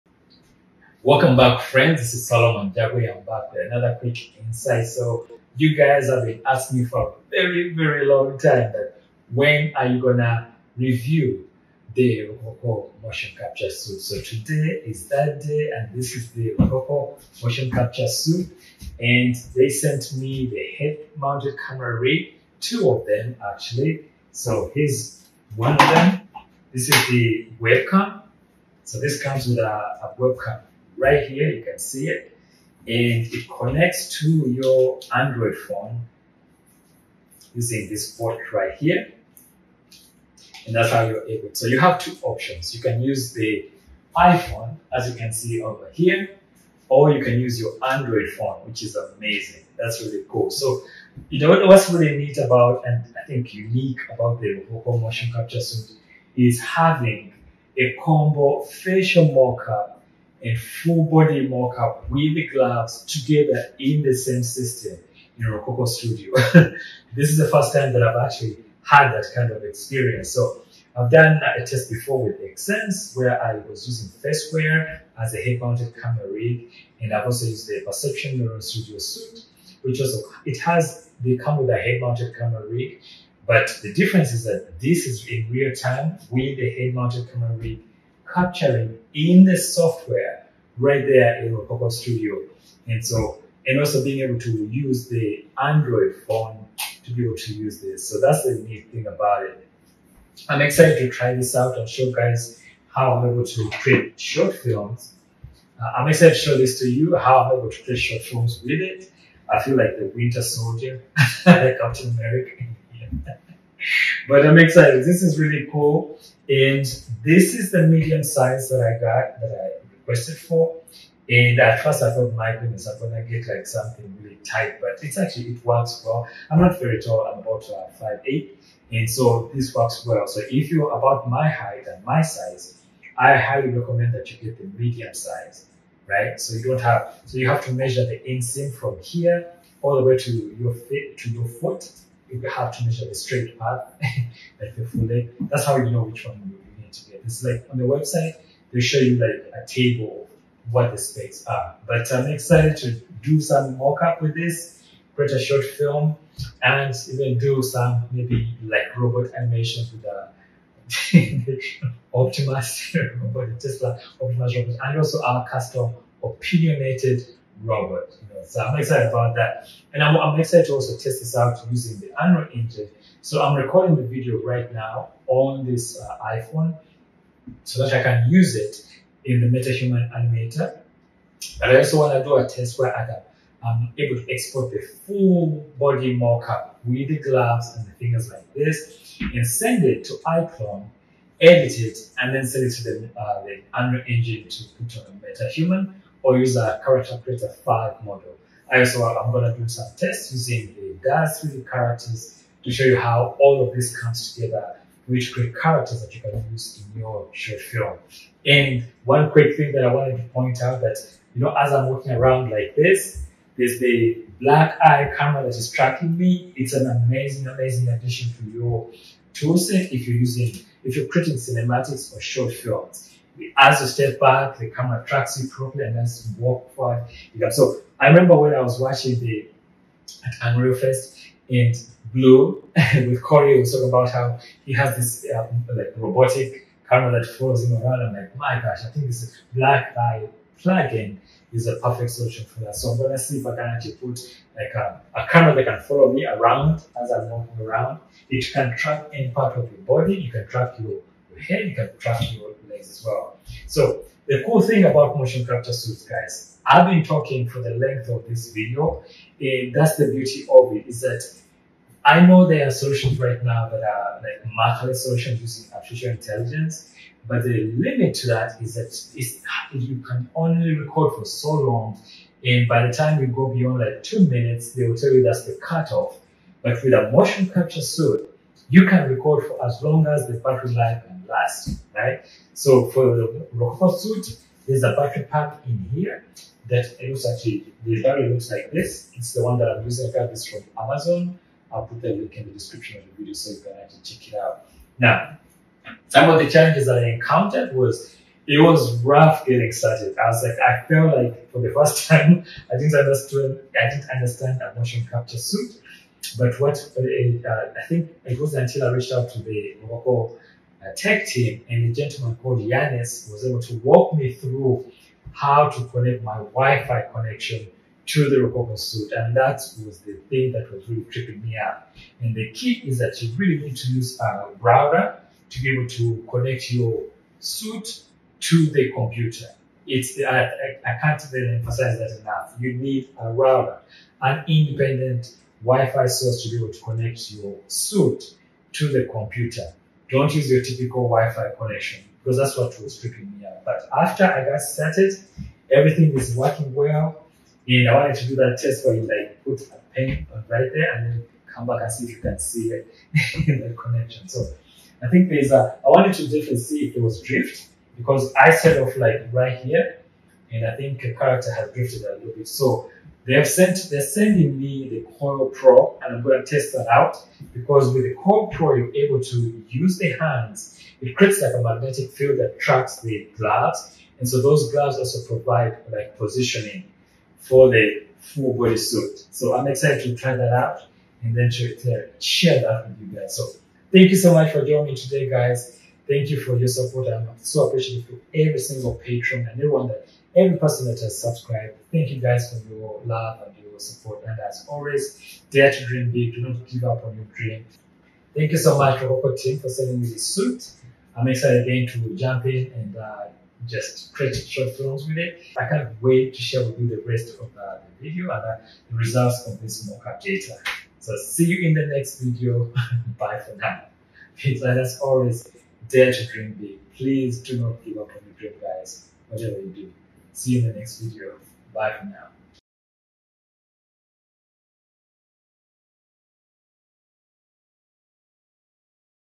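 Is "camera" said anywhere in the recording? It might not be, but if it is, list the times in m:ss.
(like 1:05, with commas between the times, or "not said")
0:21, 1:16, 1:22, 1:27, 3:35, 3:44, 3:56, 4:05.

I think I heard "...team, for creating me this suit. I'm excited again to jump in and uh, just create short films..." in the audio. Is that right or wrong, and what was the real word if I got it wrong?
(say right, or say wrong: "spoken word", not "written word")
wrong: "sending", not "creating".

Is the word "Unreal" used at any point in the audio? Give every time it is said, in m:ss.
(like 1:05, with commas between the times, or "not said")
2:52, 3:13, 3:50.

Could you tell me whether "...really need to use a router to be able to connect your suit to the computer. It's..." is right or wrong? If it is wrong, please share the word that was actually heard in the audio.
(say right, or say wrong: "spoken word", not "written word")
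right.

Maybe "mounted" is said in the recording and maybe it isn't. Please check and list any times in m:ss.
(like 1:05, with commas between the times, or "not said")
0:21, 1:15, 1:21, 1:26.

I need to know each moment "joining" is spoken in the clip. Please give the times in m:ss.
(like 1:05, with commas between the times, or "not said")
6:24.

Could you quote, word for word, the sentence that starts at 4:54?
Now, some of the challenges that I encountered was it was rough getting started.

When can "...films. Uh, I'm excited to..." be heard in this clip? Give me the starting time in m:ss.
1:44.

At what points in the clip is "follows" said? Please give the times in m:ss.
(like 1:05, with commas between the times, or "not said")
3:57, 4:05.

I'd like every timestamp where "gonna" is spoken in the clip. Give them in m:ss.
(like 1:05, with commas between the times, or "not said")
0:09, 2:02, 4:02.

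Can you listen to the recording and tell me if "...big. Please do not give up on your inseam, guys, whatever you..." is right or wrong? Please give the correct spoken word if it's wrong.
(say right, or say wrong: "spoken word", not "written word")
wrong: "dream", not "inseam".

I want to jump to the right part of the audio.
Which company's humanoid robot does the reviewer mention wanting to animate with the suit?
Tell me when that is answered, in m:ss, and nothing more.
2:43.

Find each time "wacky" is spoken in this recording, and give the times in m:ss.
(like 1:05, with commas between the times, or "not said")
not said.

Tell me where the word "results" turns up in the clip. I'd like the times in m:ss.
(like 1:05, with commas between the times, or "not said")
6:48.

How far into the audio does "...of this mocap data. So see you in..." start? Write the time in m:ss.
6:49.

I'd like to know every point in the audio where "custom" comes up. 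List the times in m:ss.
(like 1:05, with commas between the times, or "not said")
2:45.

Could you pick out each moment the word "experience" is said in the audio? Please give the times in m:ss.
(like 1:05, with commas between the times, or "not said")
1:09.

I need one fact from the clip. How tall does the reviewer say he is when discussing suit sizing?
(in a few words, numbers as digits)
5 foot 8.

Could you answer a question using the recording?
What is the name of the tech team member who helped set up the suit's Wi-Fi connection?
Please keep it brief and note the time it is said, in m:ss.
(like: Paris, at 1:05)
Yanis, at 5:12.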